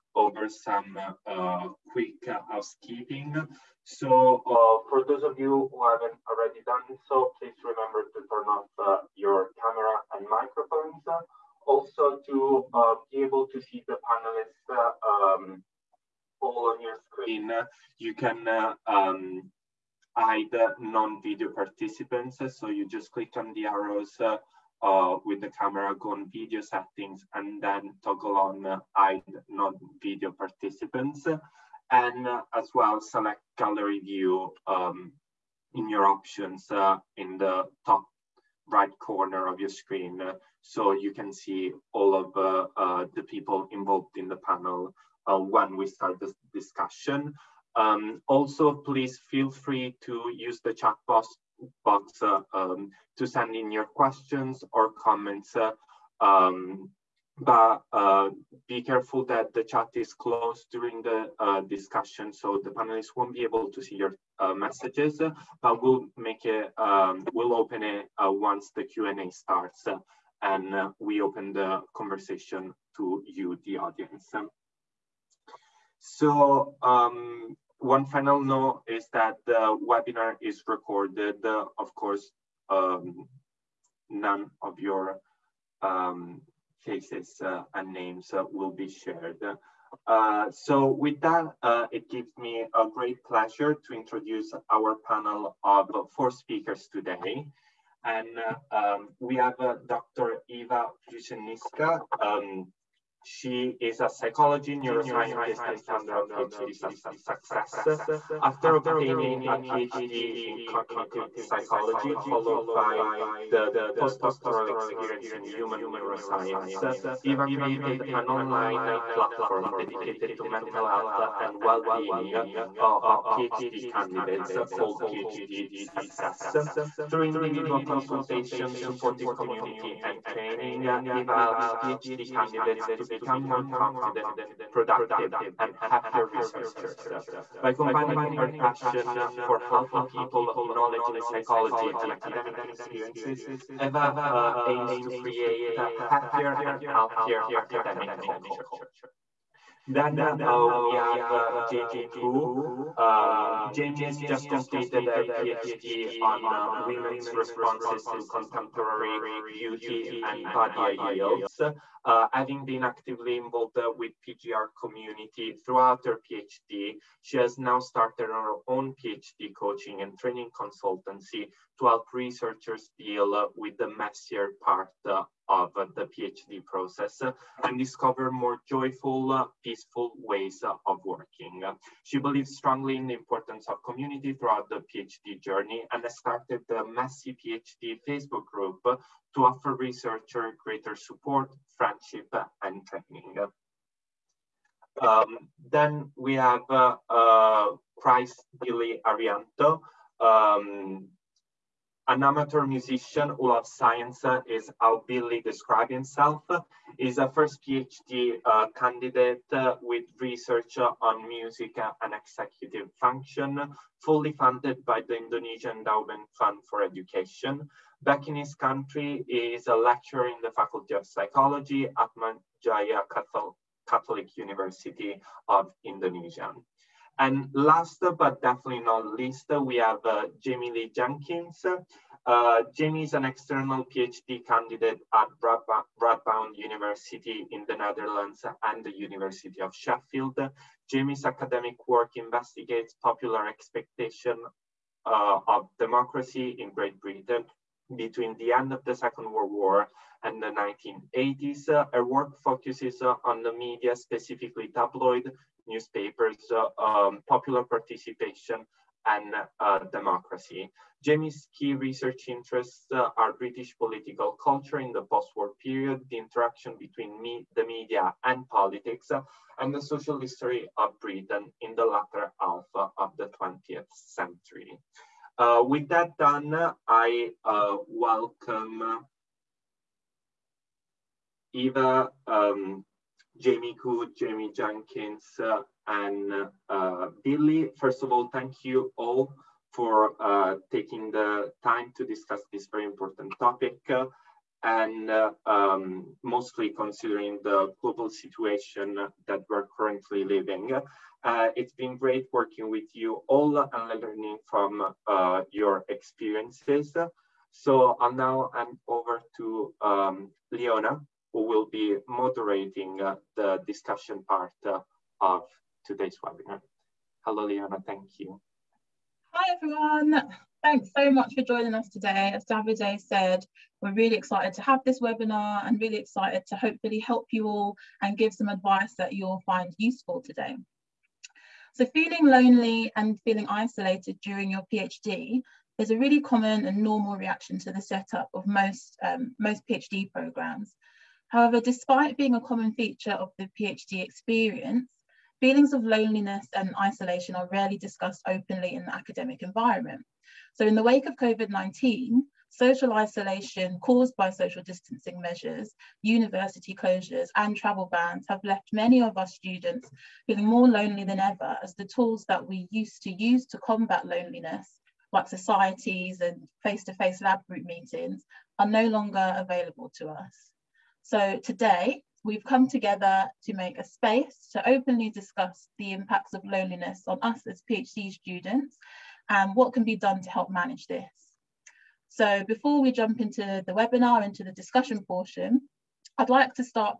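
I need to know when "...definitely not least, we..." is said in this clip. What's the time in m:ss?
3:48.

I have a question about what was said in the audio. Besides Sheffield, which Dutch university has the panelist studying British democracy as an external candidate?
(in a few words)
Radboud University.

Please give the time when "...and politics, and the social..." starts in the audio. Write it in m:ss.
4:28.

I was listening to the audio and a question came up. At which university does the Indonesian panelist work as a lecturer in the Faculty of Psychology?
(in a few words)
Atma Jaya Catholic University of Indonesia.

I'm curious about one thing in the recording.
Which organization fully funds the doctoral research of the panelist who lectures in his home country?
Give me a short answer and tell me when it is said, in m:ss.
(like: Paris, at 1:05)
Indonesian Endowment Fund for Education, at 3:35.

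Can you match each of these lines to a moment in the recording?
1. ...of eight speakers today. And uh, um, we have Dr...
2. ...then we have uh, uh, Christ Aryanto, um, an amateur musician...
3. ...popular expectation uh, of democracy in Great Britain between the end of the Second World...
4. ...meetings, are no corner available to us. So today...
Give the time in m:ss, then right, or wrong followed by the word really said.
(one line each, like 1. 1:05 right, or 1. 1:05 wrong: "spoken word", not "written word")
1. 1:35 wrong: "four", not "eight"
2. 3:15 right
3. 4:03 right
4. 6:07 wrong: "longer", not "corner".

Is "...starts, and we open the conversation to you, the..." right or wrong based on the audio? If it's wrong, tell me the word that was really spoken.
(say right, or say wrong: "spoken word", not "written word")
right.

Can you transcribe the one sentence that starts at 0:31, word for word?
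And uh, as well, select gallery view um, in your options uh, in the top right corner of your screen.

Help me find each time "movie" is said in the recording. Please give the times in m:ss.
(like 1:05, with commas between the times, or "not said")
not said.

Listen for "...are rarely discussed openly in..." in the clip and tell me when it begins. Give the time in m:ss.
5:47.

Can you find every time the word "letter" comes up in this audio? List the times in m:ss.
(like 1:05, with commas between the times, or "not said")
not said.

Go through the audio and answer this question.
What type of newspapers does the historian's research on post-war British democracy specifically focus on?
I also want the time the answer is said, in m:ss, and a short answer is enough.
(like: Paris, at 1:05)
Tabloid, at 4:14.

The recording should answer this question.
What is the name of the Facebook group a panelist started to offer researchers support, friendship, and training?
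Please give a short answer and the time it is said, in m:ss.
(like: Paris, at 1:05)
Messy PhD, at 3:06.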